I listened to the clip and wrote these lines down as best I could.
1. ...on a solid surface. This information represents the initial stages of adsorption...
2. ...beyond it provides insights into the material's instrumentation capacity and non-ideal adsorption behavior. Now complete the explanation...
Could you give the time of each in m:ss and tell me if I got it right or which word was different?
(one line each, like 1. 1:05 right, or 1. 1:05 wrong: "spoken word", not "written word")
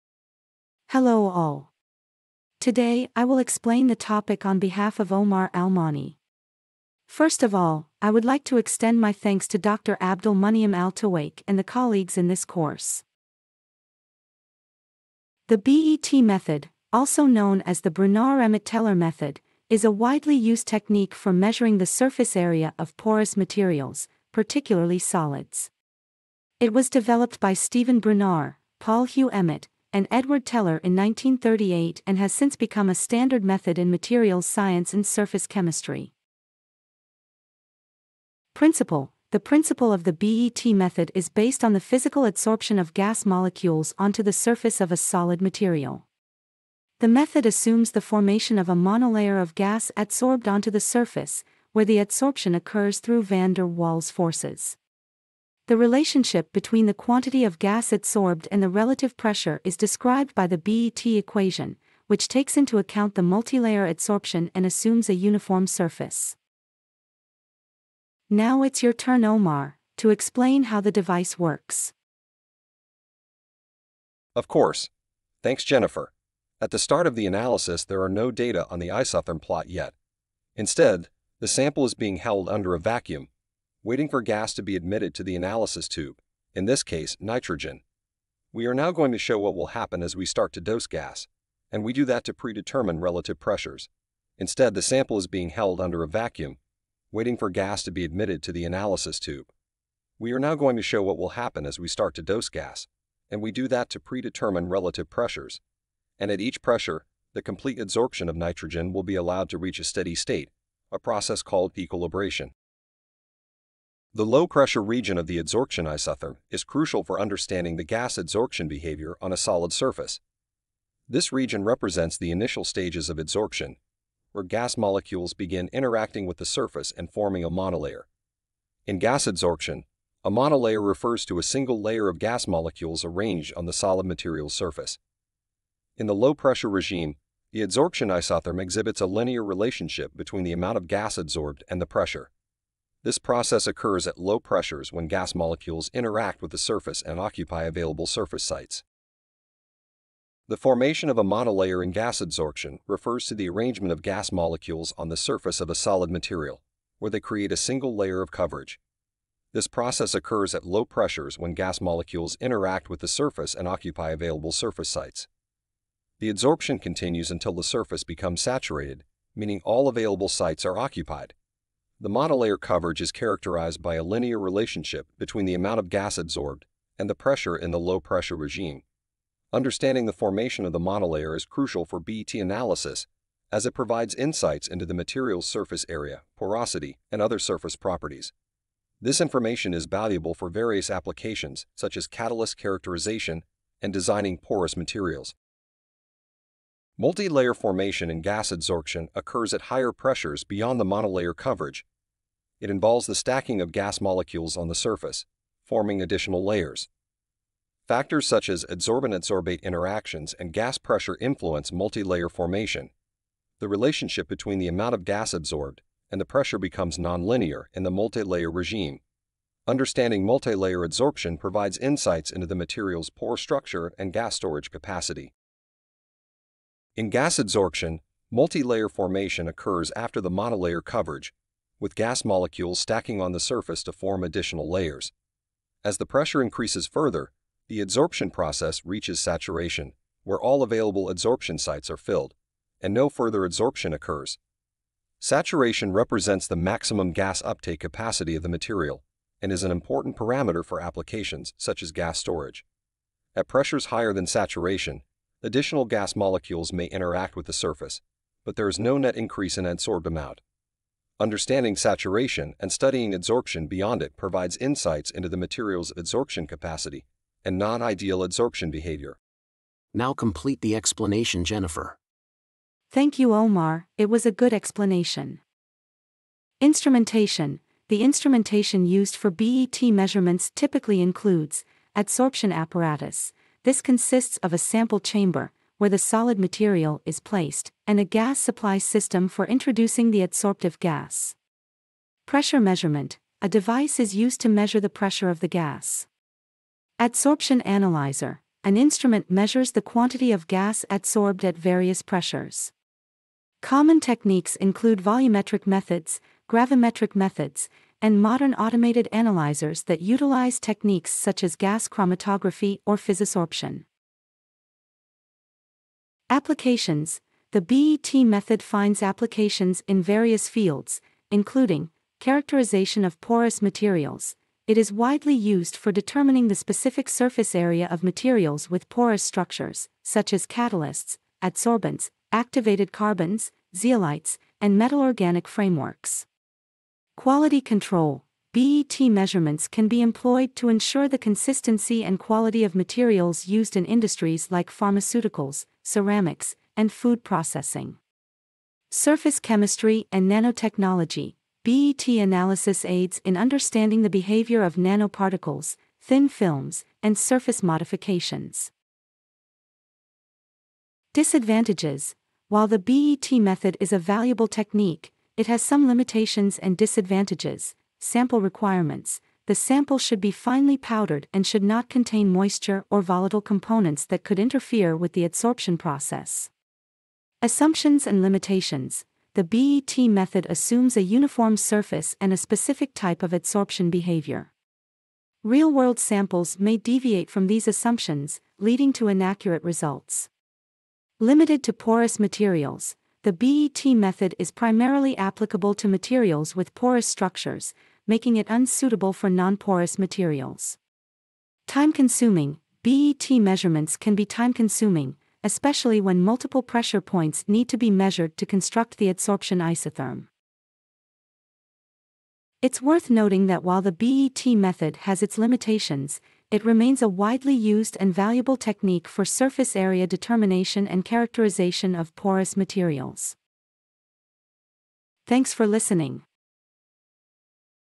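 1. 1:59 wrong: "region", not "information"
2. 4:23 wrong: "adsorption", not "instrumentation".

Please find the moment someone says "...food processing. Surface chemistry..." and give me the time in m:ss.
5:46.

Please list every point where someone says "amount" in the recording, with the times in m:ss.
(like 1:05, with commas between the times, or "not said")
2:20, 2:55, 3:34, 4:20.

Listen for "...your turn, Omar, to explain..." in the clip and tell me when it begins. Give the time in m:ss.
1:08.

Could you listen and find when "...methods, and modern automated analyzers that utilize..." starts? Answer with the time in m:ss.
5:07.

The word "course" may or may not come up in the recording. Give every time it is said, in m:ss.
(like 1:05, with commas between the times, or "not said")
0:12, 1:14.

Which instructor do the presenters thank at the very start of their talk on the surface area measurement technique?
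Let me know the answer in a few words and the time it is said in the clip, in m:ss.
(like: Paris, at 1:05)
Dr. Abdul Muniam Al Tawake, at 0:09.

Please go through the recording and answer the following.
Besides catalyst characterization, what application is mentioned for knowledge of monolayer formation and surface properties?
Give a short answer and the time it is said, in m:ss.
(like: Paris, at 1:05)
designing porous materials, at 3:13.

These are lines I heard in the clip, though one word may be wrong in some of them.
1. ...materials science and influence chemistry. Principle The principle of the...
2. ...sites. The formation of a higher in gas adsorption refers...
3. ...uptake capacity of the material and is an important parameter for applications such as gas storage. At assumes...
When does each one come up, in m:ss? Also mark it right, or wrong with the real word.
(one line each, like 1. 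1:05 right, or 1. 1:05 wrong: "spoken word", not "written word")
1. 0:33 wrong: "surface", not "influence"
2. 2:28 wrong: "monolayer", not "higher"
3. 4:07 wrong: "pressures", not "assumes".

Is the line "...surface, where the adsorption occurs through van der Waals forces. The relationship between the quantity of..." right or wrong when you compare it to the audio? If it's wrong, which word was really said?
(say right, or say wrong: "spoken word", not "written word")
right.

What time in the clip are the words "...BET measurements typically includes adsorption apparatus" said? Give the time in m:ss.
4:39.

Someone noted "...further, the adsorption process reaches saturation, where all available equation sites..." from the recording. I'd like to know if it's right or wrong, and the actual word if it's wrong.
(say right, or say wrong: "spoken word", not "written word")
wrong: "adsorption", not "equation".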